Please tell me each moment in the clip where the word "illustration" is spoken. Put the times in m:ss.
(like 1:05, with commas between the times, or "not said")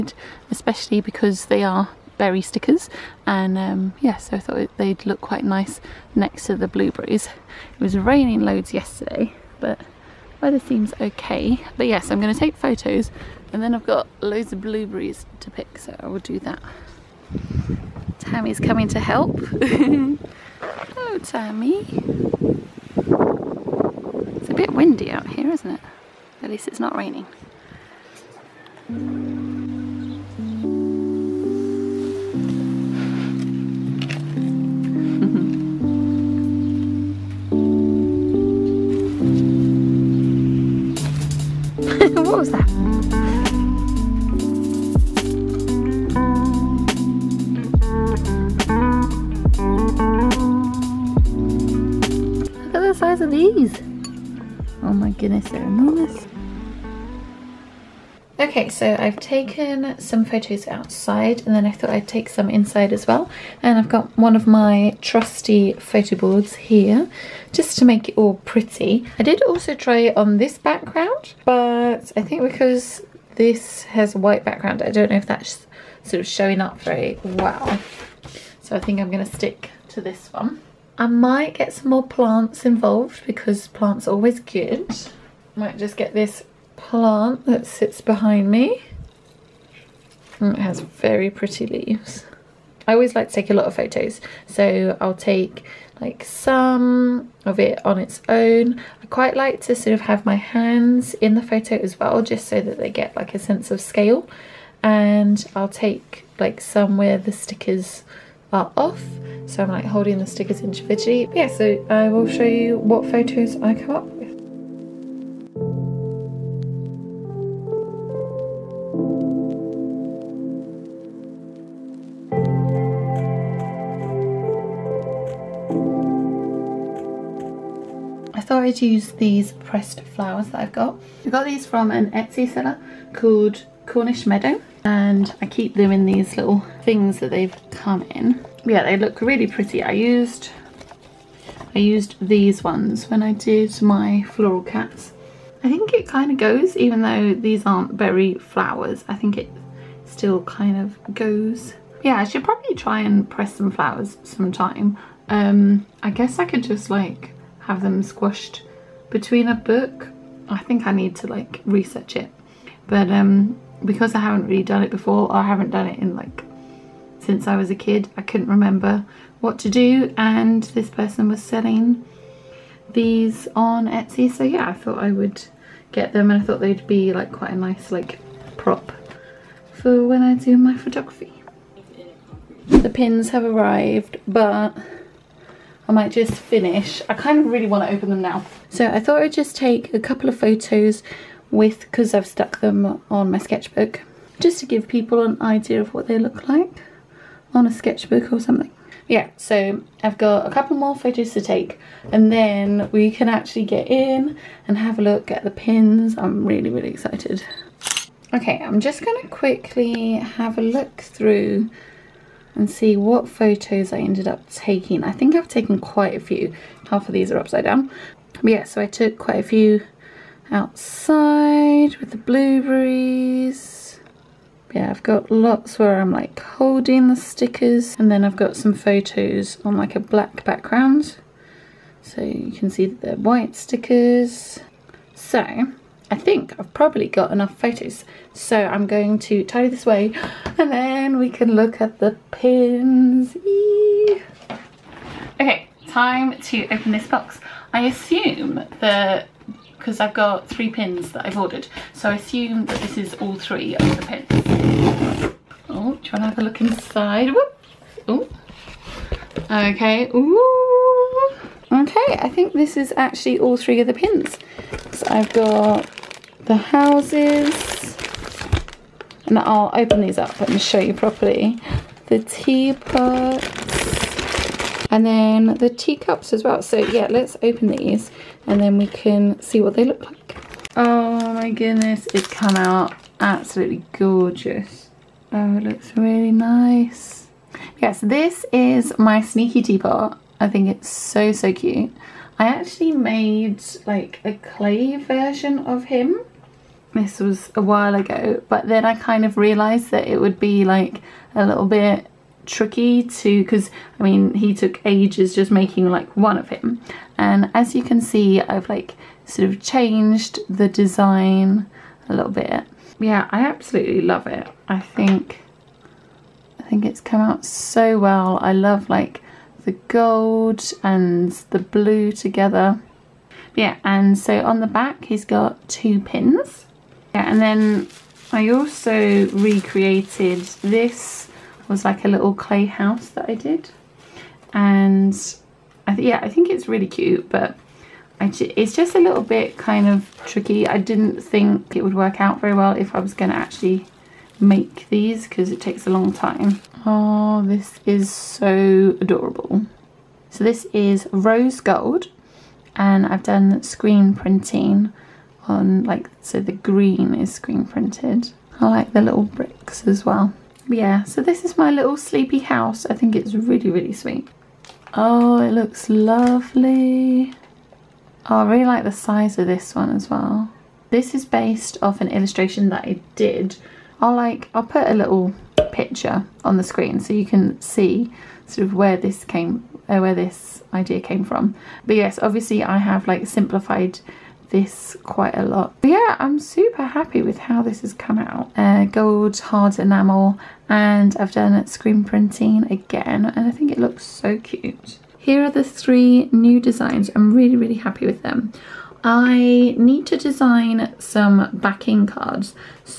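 6:12.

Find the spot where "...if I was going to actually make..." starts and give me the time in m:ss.
5:42.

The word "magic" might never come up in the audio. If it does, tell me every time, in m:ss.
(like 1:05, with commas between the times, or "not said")
not said.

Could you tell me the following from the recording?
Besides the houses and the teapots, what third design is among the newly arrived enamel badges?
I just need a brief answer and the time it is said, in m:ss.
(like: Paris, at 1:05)
Teacups, at 4:35.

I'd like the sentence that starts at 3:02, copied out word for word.
The pins have arrived, but I might just finish.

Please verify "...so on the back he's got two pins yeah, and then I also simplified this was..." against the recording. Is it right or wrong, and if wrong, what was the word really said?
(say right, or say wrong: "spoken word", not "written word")
wrong: "recreated", not "simplified".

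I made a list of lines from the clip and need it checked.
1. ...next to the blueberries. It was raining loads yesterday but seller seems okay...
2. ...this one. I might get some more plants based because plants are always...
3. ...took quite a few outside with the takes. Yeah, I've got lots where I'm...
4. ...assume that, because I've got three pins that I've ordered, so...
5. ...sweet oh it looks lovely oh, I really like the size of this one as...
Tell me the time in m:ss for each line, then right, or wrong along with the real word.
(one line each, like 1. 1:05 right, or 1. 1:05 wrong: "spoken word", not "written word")
1. 0:06 wrong: "weather", not "seller"
2. 1:19 wrong: "involved", not "based"
3. 3:38 wrong: "blueberries", not "takes"
4. 4:07 right
5. 6:03 right.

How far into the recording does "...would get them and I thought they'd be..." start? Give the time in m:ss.
2:55.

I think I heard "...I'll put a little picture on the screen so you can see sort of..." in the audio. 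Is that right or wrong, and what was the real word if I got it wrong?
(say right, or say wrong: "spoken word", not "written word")
right.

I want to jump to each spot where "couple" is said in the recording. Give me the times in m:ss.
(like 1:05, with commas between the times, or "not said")
3:09, 3:20.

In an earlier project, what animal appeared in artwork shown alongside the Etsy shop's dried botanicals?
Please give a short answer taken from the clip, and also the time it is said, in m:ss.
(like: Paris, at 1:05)
Cats, at 2:24.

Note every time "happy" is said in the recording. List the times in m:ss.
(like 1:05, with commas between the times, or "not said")
6:26, 6:37.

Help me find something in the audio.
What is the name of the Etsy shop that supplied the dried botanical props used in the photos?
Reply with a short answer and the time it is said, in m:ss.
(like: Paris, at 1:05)
Cornish Meadow, at 2:13.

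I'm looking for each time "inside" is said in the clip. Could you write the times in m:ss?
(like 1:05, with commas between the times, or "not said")
1:02, 4:16.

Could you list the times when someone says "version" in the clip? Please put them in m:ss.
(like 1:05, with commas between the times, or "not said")
4:54.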